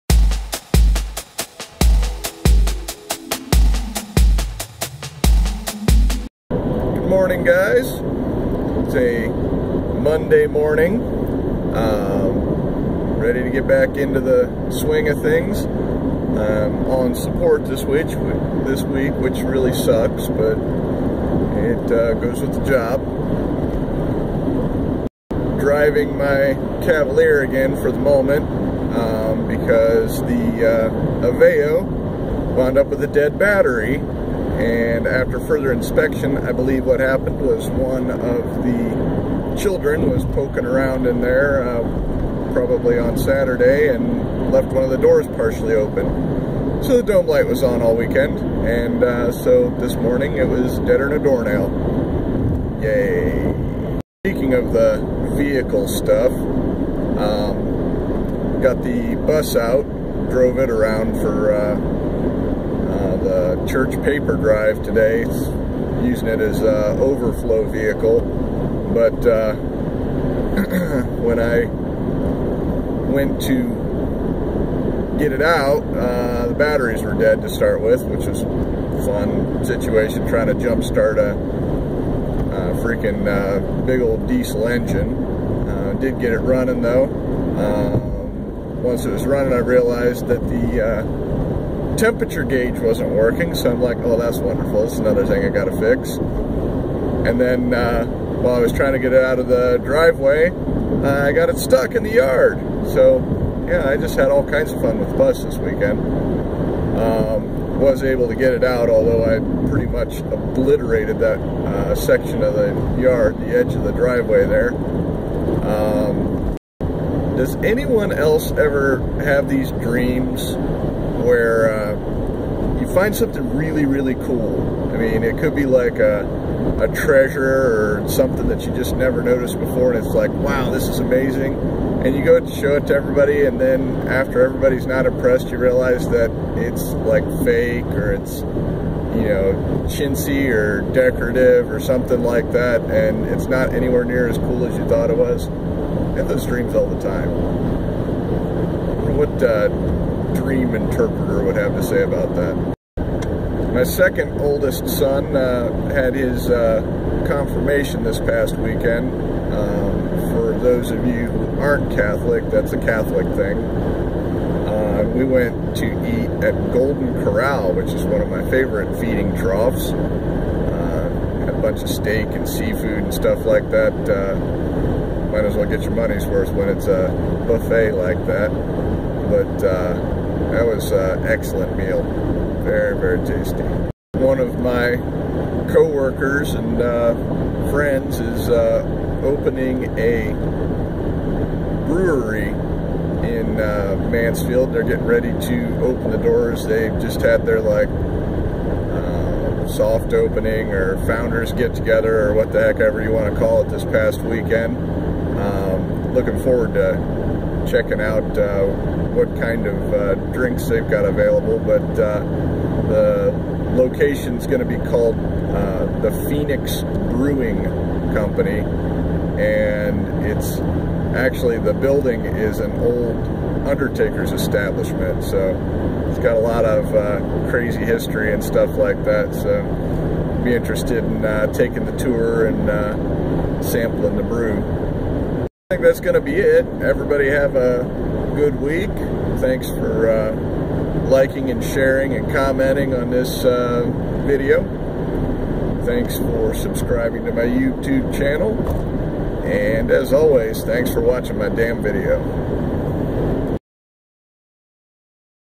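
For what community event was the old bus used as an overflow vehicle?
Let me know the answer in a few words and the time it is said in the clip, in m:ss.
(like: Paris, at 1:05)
church paper drive, at 1:03.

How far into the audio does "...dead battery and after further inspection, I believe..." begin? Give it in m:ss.
0:33.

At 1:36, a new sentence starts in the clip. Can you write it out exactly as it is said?
And then uh, while I was trying to get it out of the driveway, uh, I got it stuck in the yard.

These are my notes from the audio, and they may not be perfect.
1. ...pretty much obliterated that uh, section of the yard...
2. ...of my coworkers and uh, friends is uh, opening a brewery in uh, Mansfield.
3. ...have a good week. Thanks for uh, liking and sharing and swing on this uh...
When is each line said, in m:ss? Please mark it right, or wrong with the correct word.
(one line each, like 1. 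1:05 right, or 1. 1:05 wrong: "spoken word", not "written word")
1. 1:49 right
2. 3:04 right
3. 3:57 wrong: "commenting", not "swing".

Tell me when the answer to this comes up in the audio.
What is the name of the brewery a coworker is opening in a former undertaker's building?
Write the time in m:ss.
3:36.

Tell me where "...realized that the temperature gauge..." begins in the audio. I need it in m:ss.
1:29.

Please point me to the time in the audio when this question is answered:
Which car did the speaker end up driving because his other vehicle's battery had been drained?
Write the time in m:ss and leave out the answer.
0:26.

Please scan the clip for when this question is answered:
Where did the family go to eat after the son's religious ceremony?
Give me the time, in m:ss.
2:46.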